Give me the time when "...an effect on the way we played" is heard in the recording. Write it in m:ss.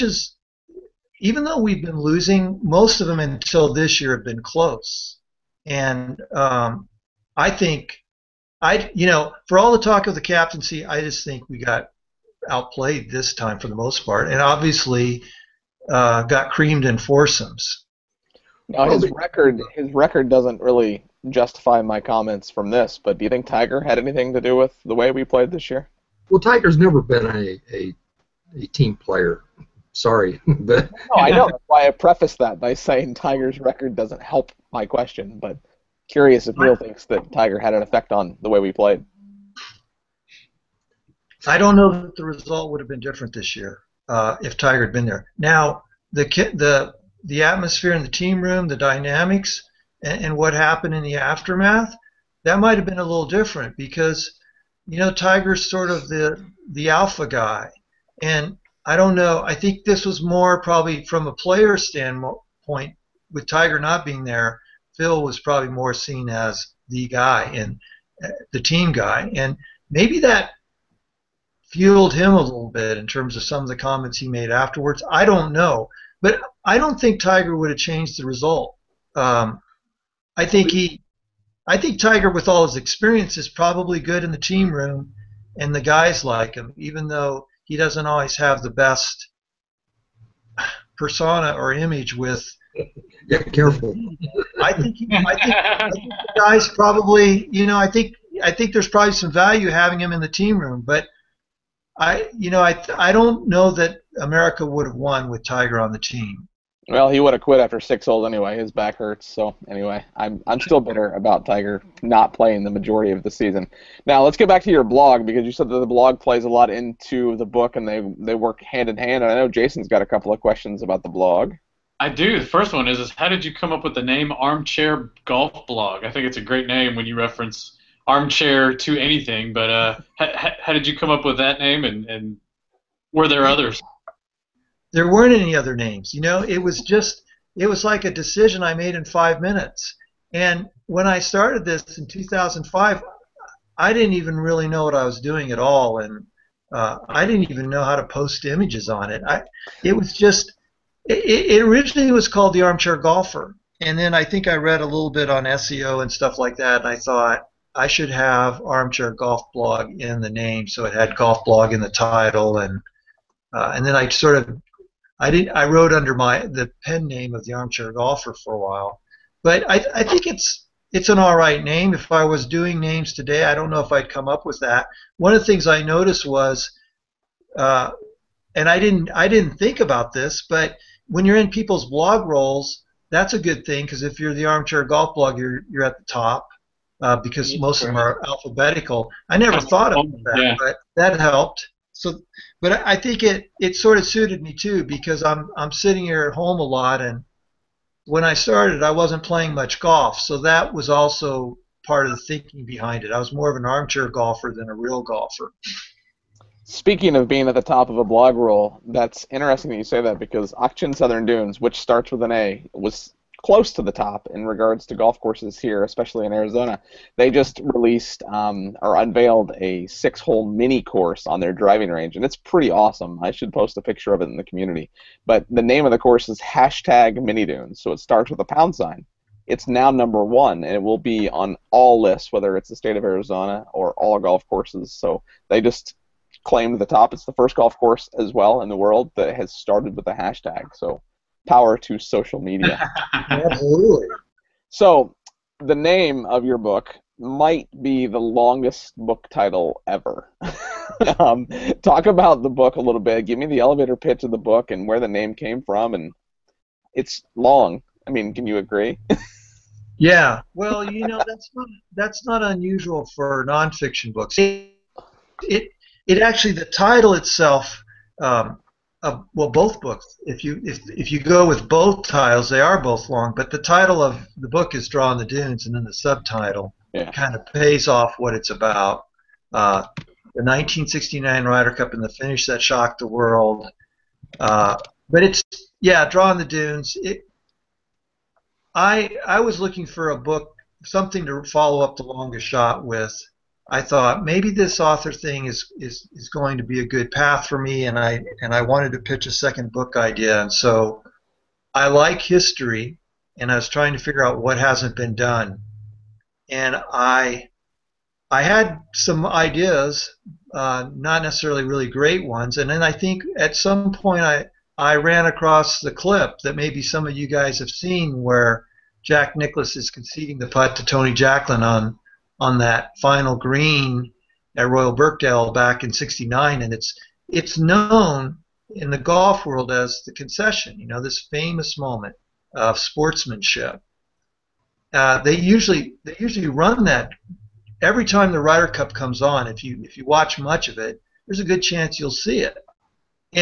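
0:37.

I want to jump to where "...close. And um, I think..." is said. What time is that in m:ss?
0:04.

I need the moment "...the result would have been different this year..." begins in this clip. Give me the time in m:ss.
0:42.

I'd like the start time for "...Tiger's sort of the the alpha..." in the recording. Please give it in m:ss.
0:55.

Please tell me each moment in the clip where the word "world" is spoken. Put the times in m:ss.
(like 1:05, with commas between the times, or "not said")
3:58, 4:43, 5:29.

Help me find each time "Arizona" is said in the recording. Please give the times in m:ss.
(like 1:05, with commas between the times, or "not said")
3:36, 3:53.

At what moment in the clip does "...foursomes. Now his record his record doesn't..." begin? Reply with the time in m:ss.
0:16.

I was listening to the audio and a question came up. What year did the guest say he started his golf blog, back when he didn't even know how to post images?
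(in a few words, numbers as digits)
2005.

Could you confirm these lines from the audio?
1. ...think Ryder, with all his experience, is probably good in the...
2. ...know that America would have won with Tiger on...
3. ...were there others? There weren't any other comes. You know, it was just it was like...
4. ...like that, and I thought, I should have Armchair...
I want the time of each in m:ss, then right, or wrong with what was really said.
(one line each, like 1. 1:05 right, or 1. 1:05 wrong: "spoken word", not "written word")
1. 1:21 wrong: "Tiger", not "Ryder"
2. 1:43 right
3. 2:13 wrong: "names", not "comes"
4. 2:36 right.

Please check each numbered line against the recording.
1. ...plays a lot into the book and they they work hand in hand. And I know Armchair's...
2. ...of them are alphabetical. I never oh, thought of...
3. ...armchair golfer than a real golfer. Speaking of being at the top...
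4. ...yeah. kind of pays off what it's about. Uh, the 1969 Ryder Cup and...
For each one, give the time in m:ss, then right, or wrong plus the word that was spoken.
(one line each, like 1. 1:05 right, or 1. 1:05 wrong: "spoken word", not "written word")
1. 1:56 wrong: "Jason", not "Armchair"
2. 3:07 right
3. 3:23 right
4. 4:36 right.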